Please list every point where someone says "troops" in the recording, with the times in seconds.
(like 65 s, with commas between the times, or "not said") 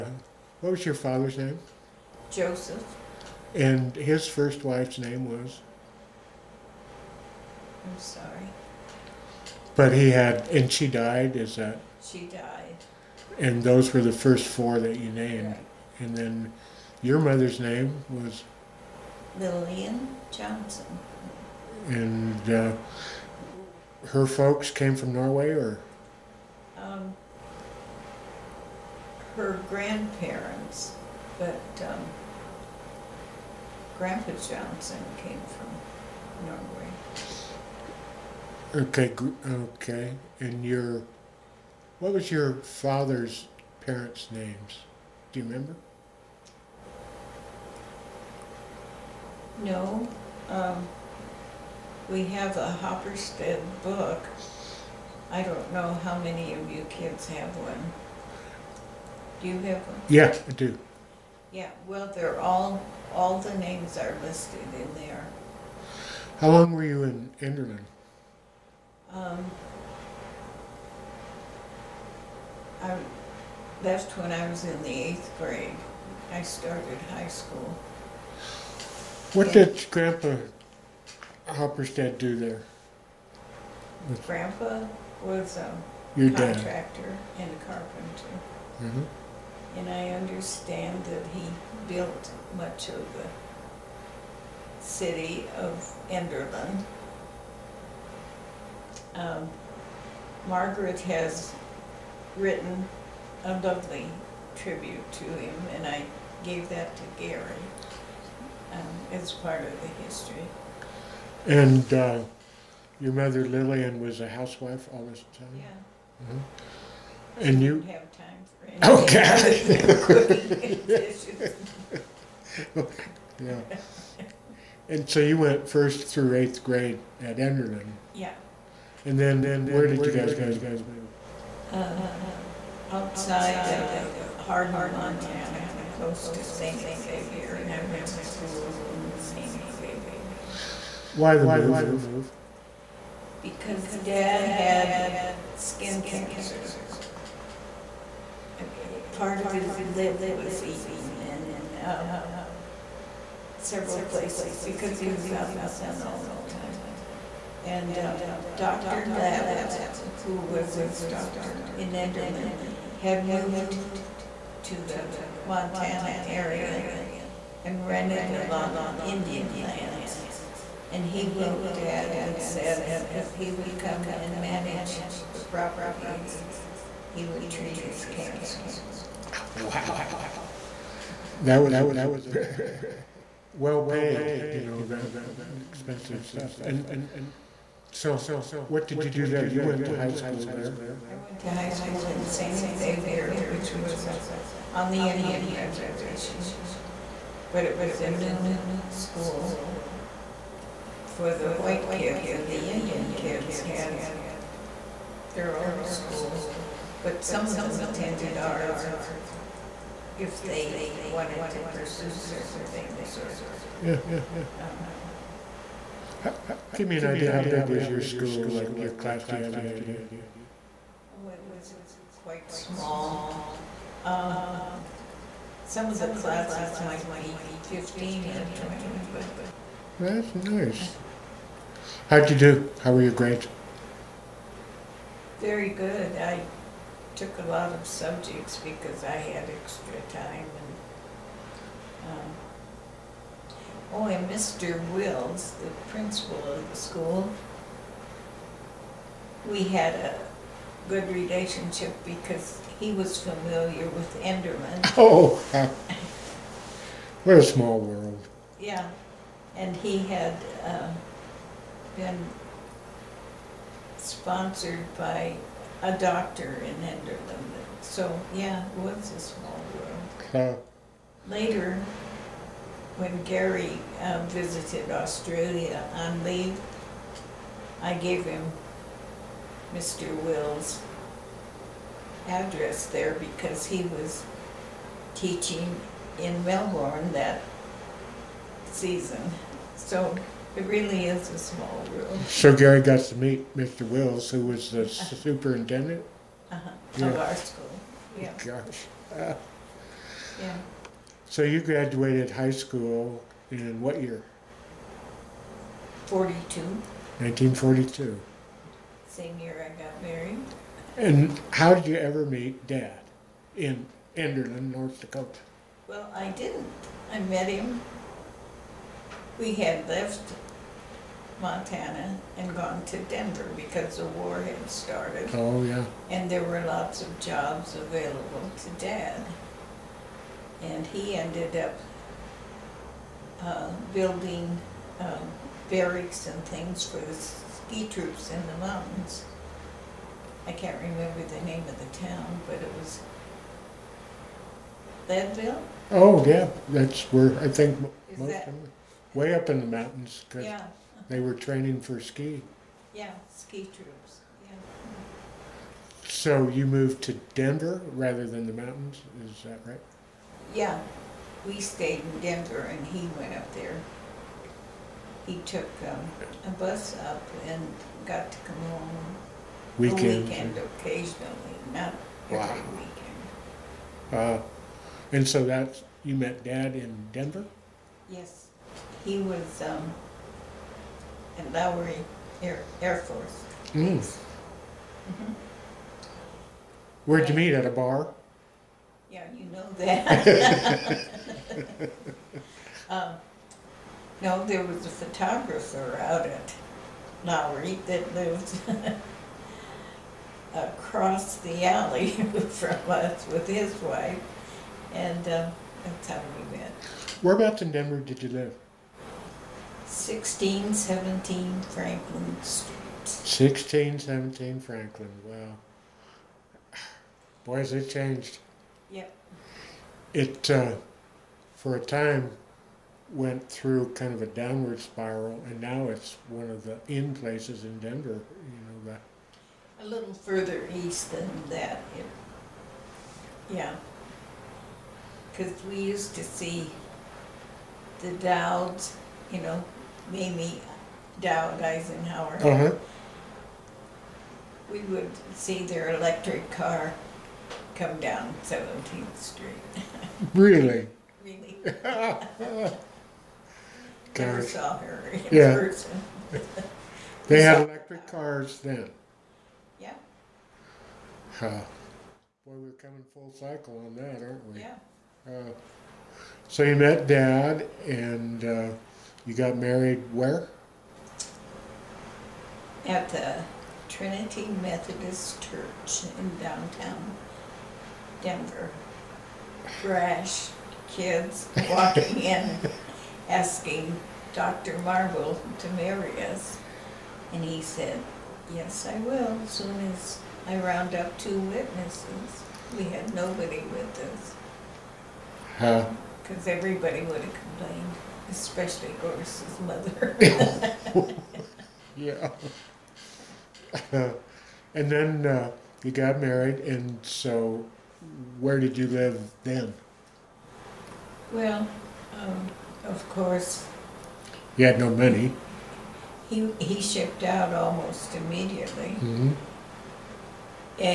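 337 s, 353 s.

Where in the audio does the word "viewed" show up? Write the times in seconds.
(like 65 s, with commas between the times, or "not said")
not said.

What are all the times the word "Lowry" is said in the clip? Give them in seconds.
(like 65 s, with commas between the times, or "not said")
381 s, 397 s.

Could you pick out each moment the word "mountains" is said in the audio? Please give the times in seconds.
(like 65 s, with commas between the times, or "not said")
338 s, 349 s, 358 s.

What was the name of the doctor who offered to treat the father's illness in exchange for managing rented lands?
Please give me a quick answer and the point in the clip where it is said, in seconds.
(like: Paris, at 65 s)
Dr. Labatt, at 158 s.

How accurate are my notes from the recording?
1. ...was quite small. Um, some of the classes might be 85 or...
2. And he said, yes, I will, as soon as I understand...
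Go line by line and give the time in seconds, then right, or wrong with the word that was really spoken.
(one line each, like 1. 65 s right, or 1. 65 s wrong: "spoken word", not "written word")
1. 221 s wrong: "15", not "85"
2. 487 s wrong: "round", not "understand".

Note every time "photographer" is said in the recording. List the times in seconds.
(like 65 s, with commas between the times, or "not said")
394 s.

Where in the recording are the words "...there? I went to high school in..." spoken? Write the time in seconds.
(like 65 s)
190 s.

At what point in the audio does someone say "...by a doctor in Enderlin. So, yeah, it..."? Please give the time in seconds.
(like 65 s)
264 s.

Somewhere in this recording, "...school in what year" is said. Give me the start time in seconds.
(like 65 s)
302 s.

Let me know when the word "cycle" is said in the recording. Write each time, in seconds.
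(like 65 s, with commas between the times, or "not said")
463 s.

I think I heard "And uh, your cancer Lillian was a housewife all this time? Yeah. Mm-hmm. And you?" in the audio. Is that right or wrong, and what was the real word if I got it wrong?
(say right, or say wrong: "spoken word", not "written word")
wrong: "mother", not "cancer".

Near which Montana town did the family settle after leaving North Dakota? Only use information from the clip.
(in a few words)
Hardin.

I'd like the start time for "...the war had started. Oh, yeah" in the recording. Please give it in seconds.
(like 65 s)
323 s.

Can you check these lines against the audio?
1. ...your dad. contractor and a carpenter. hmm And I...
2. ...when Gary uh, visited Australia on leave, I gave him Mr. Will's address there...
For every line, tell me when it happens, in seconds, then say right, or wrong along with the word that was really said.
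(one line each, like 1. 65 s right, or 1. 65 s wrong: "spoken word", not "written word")
1. 86 s right
2. 272 s right.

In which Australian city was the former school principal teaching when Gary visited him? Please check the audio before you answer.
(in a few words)
Melbourne.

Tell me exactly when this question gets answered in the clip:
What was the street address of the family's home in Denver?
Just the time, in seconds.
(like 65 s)
409 s.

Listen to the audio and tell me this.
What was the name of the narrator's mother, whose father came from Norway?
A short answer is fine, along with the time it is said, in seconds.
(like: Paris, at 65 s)
Lillian Johnson, at 19 s.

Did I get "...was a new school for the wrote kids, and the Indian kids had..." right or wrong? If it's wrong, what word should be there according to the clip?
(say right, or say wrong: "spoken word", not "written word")
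wrong: "white", not "wrote".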